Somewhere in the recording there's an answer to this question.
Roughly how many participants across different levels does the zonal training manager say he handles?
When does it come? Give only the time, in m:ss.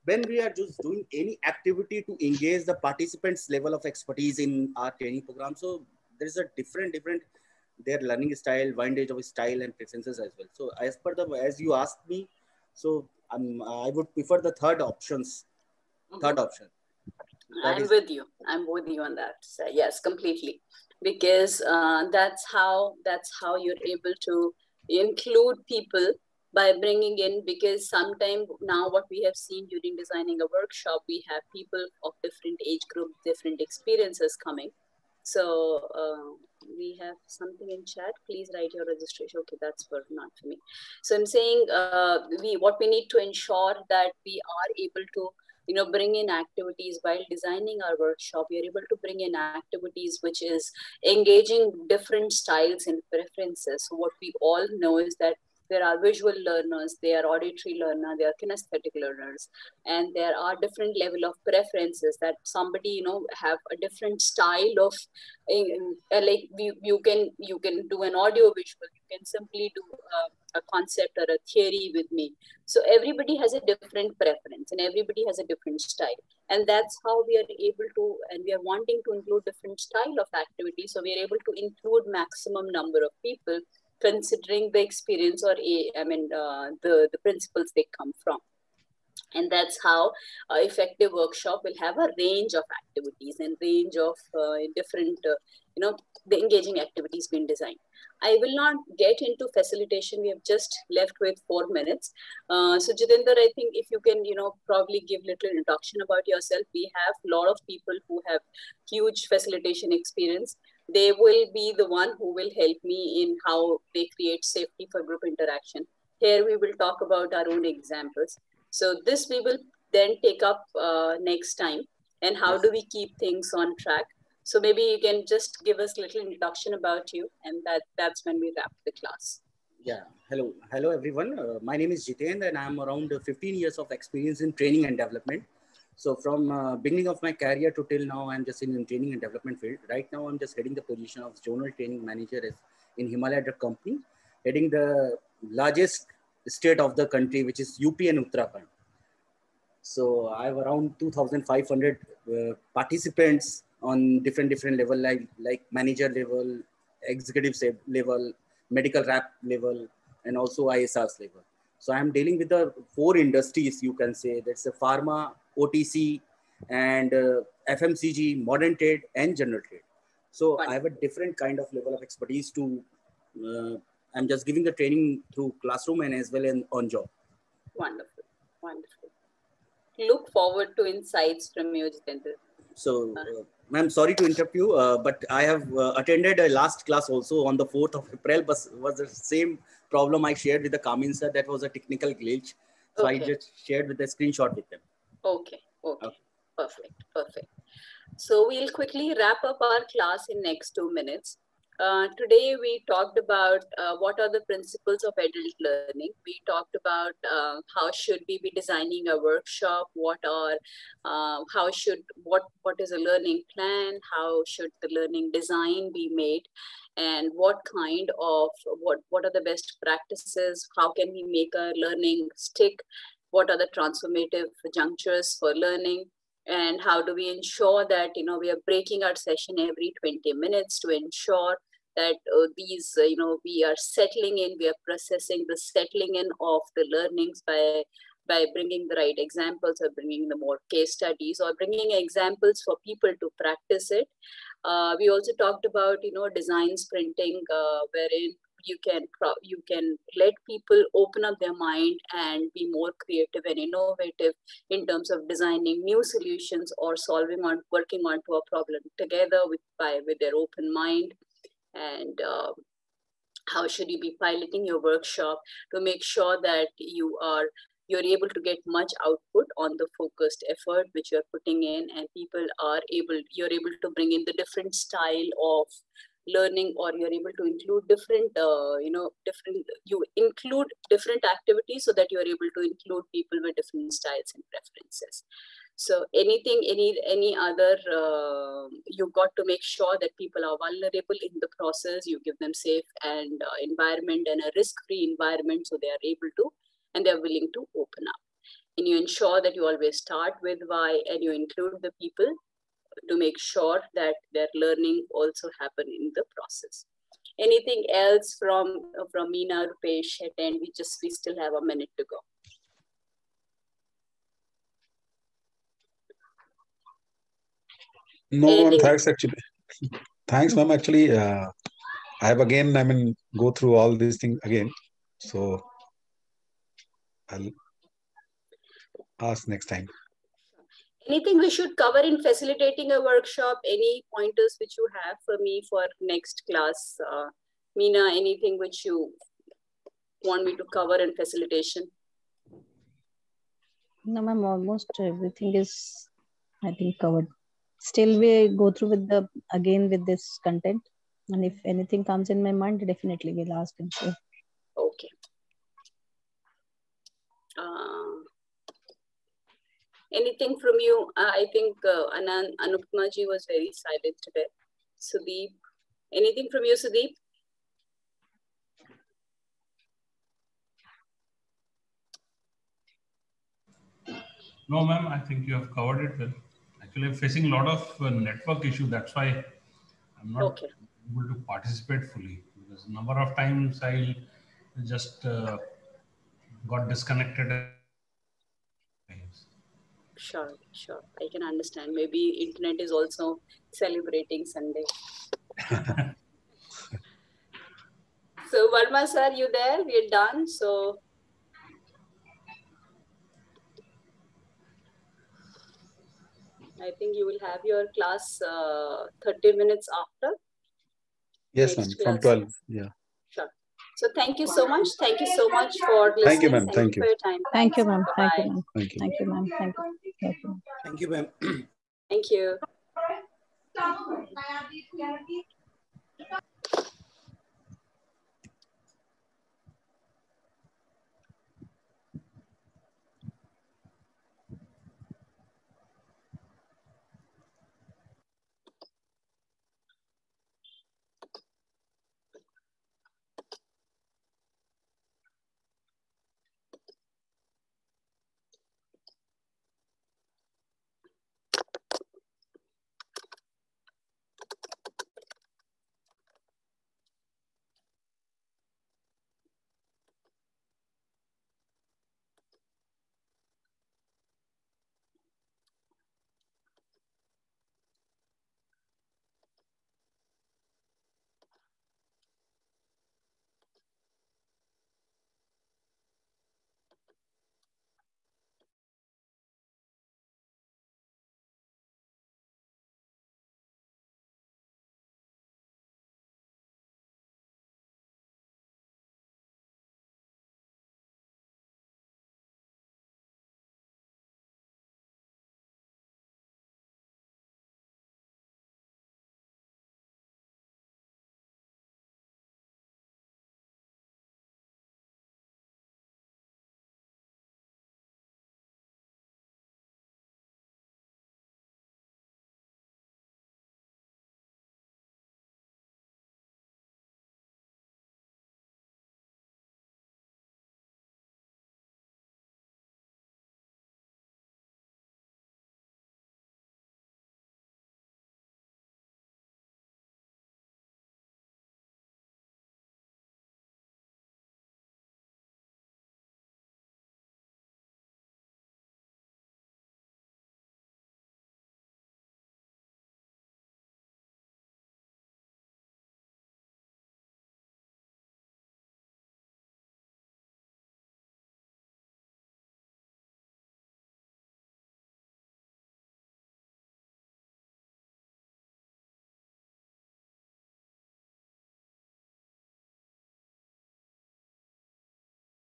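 2:30.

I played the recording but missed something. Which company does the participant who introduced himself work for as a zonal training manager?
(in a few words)
Himalaya Drug Company.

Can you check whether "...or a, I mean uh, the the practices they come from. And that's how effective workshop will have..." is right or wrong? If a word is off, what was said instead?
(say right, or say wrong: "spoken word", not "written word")
wrong: "principles", not "practices".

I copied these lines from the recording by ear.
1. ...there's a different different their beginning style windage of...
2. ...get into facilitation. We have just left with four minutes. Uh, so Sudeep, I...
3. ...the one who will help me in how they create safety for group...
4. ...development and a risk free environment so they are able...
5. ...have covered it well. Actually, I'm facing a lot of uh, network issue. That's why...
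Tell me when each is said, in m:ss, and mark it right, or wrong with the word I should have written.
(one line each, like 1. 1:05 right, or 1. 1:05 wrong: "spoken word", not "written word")
1. 0:06 wrong: "learning", not "beginning"
2. 1:38 wrong: "Jitendra", not "Sudeep"
3. 1:51 right
4. 4:53 wrong: "environment", not "development"
5. 6:15 right.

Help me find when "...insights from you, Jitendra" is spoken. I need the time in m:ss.
3:00.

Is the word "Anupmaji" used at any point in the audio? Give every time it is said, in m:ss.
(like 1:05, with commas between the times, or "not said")
6:02.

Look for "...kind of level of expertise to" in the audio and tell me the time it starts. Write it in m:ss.
2:51.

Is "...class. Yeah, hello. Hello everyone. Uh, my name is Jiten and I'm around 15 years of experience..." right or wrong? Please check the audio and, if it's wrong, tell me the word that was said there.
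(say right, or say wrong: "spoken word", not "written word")
right.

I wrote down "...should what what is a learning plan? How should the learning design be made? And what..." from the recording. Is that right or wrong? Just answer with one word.
right.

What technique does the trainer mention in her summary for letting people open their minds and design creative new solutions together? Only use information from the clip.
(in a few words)
design sprinting.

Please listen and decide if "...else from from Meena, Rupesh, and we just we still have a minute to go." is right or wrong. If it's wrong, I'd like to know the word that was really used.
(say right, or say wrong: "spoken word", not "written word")
right.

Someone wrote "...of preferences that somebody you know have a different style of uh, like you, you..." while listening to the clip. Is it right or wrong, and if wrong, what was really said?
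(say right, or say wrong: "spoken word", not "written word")
right.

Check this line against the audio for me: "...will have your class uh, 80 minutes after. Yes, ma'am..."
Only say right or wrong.
wrong.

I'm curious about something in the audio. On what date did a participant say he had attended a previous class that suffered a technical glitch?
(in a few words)
4th of April.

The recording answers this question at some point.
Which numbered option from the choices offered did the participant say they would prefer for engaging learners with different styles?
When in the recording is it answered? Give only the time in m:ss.
0:16.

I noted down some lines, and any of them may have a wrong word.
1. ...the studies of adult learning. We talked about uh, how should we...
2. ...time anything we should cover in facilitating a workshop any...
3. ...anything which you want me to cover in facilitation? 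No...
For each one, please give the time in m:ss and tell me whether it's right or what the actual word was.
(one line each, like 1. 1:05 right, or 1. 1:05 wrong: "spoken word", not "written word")
1. 3:24 wrong: "principles", not "studies"
2. 5:29 right
3. 5:38 right.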